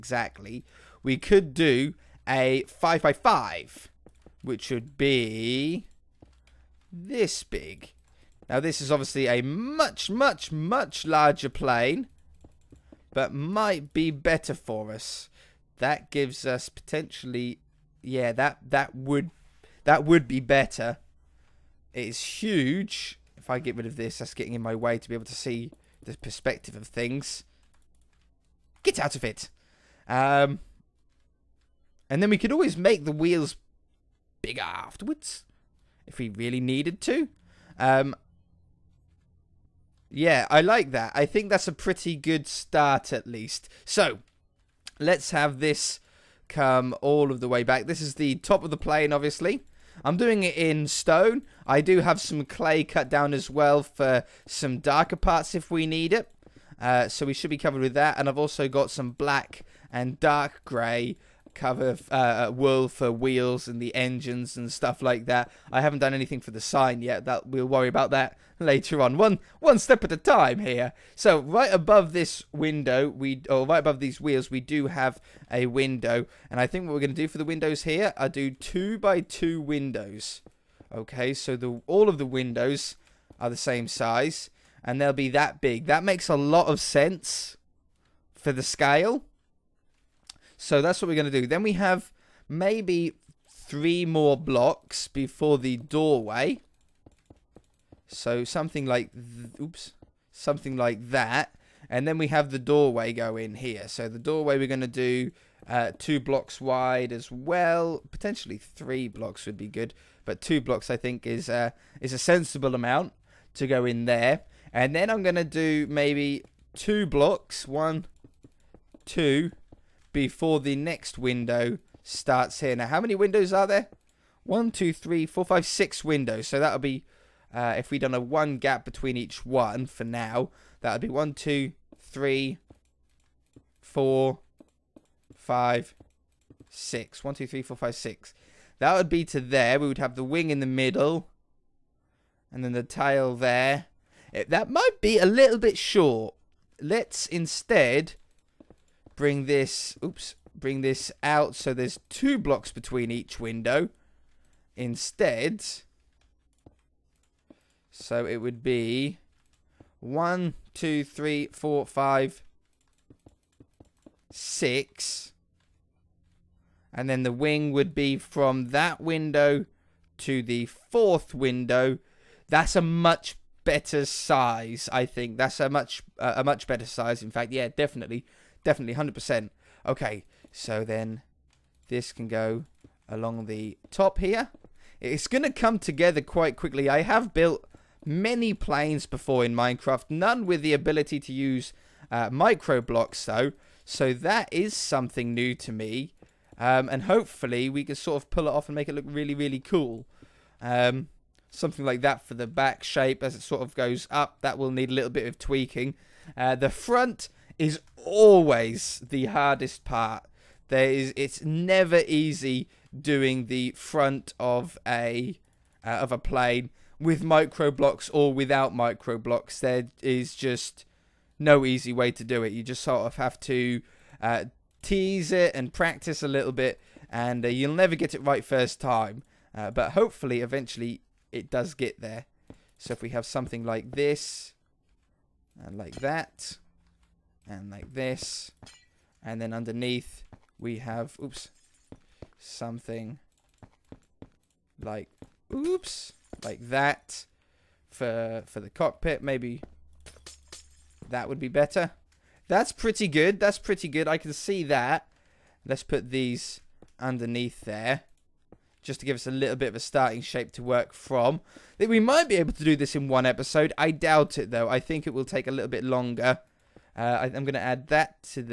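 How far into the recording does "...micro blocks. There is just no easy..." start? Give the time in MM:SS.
03:38.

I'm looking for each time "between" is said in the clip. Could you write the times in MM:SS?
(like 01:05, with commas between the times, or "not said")
02:08, 02:32.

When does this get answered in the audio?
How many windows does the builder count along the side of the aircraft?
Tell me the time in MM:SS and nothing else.
02:05.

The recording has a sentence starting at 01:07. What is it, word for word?
That We'll worry about that later on.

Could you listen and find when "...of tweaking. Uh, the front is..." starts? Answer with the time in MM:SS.
03:25.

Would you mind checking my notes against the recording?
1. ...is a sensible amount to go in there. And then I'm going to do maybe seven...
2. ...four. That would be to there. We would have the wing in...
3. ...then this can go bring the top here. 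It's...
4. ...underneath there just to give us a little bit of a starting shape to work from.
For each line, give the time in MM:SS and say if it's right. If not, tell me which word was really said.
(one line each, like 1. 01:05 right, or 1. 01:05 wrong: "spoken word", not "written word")
1. 01:51 wrong: "two", not "seven"
2. 02:17 wrong: "six", not "four"
3. 03:00 wrong: "along", not "bring"
4. 04:16 right.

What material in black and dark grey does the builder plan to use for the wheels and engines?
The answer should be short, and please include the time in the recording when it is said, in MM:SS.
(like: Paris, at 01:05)
Wool, at 01:02.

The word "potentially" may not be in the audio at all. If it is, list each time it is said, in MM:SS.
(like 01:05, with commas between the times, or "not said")
00:16, 01:48.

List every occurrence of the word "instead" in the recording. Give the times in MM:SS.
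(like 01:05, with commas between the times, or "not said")
02:27, 02:34.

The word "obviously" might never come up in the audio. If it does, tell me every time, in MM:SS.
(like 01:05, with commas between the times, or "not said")
00:08, 00:49.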